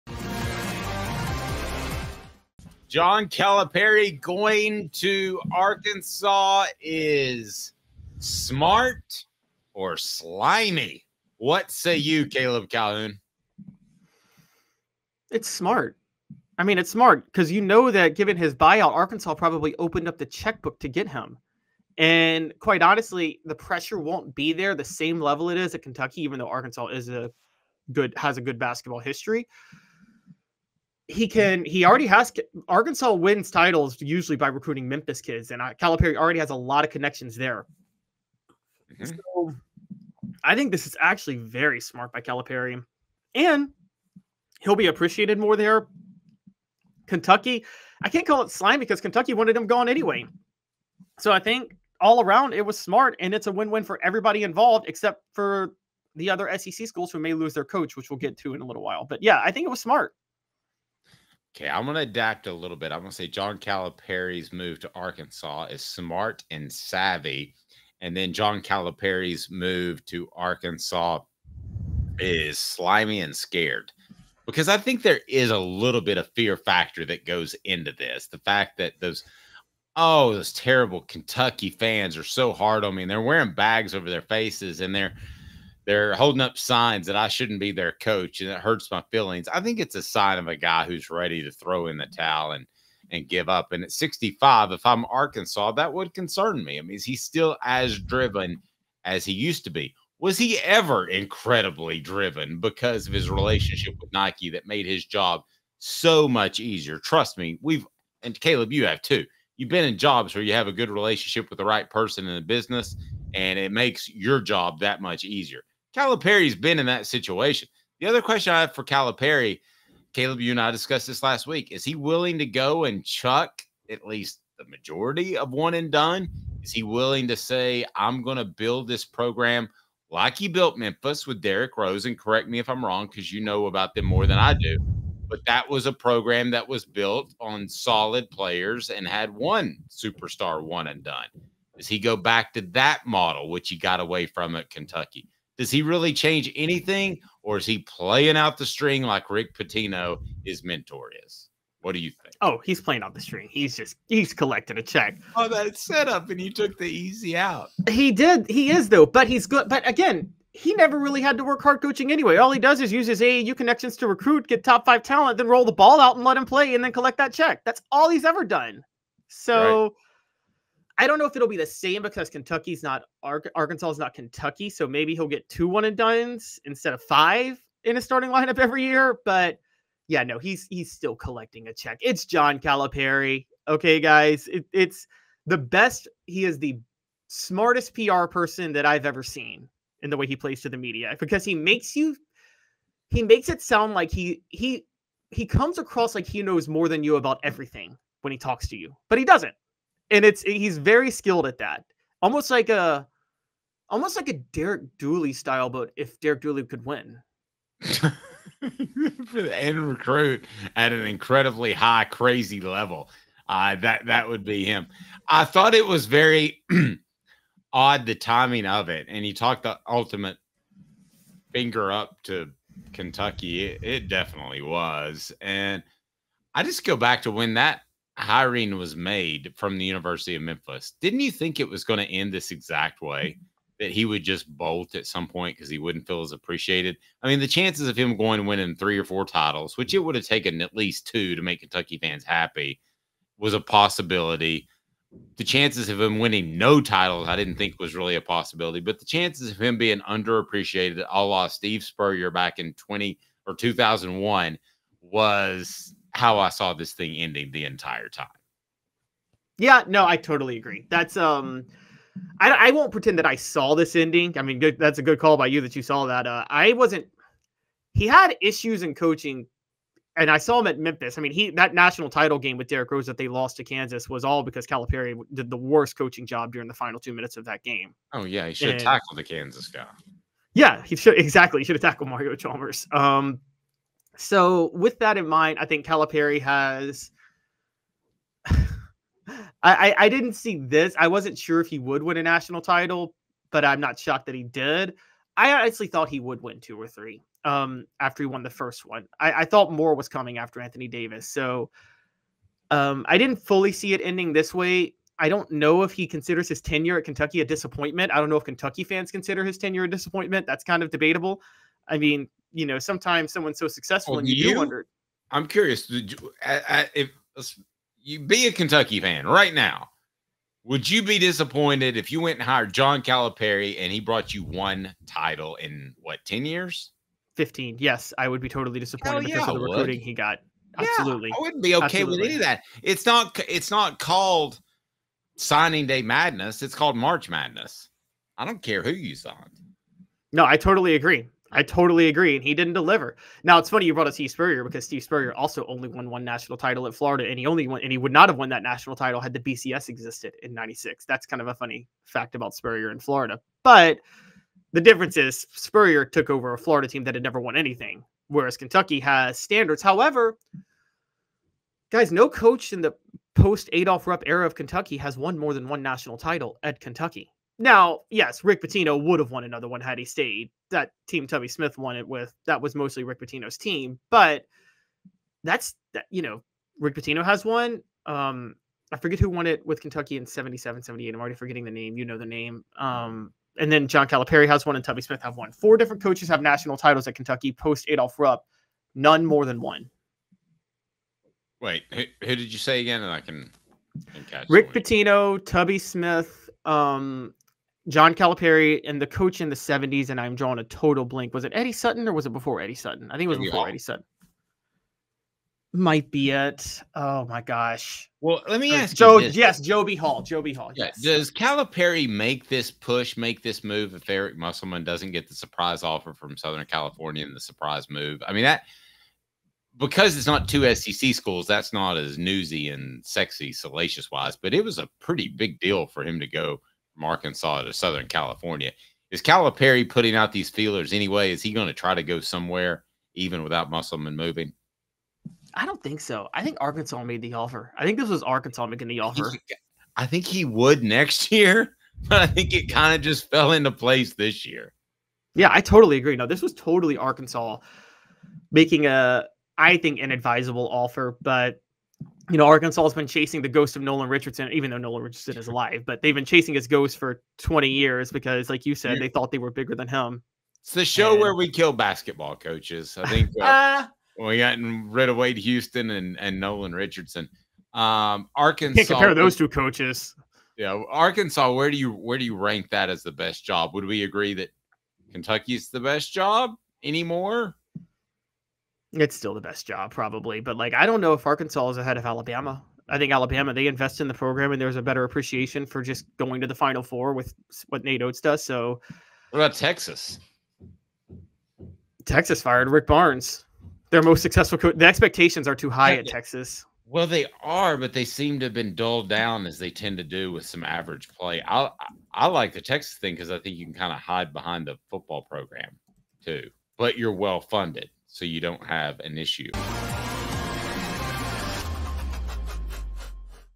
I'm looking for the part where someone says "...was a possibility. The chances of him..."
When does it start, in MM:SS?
04:03.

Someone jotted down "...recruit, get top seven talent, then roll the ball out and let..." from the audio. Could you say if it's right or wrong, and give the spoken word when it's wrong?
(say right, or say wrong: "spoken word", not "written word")
wrong: "five", not "seven".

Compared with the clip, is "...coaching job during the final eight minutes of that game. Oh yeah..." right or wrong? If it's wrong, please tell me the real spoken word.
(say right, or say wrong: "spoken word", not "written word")
wrong: "two", not "eight".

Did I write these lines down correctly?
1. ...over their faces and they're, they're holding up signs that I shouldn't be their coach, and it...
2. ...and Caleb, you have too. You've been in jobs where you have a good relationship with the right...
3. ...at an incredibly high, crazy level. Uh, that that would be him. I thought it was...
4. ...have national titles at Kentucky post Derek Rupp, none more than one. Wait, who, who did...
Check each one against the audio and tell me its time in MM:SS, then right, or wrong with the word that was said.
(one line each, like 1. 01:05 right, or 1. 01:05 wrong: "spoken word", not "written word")
1. 01:23 right
2. 01:48 right
3. 03:30 right
4. 06:26 wrong: "Adolph", not "Derek".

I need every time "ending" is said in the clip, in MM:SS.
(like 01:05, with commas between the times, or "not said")
04:17, 04:23, 05:04.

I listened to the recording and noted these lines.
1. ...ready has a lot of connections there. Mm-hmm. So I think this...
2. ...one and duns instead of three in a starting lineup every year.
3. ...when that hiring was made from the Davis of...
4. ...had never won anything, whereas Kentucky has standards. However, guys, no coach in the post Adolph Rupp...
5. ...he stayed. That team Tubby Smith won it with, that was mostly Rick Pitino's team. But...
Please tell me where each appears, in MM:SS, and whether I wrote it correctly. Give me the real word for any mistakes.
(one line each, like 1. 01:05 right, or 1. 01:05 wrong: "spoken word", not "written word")
1. 00:36 wrong: "already", not "ready"
2. 02:55 wrong: "five", not "three"
3. 03:47 wrong: "University", not "Davis"
4. 05:57 right
5. 06:09 right.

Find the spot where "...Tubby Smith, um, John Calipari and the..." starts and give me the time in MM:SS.
06:35.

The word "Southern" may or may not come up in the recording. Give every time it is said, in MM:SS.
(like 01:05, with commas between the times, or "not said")
06:56, 07:07.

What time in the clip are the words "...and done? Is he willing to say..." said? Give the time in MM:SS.
02:05.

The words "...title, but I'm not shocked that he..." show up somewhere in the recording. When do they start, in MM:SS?
04:52.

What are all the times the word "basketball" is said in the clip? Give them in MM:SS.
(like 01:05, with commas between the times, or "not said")
00:28, 07:41.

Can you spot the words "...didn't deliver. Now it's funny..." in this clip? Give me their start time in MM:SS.
05:42.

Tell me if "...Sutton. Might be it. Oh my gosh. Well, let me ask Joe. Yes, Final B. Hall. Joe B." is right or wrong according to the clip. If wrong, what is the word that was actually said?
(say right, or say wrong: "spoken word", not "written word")
wrong: "Joe", not "Final".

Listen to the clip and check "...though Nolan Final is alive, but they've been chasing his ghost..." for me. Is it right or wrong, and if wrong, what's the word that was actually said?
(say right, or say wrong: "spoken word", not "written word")
wrong: "Richardson", not "Final".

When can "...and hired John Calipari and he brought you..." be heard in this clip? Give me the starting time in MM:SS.
05:22.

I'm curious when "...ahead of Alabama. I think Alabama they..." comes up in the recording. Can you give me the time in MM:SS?
08:01.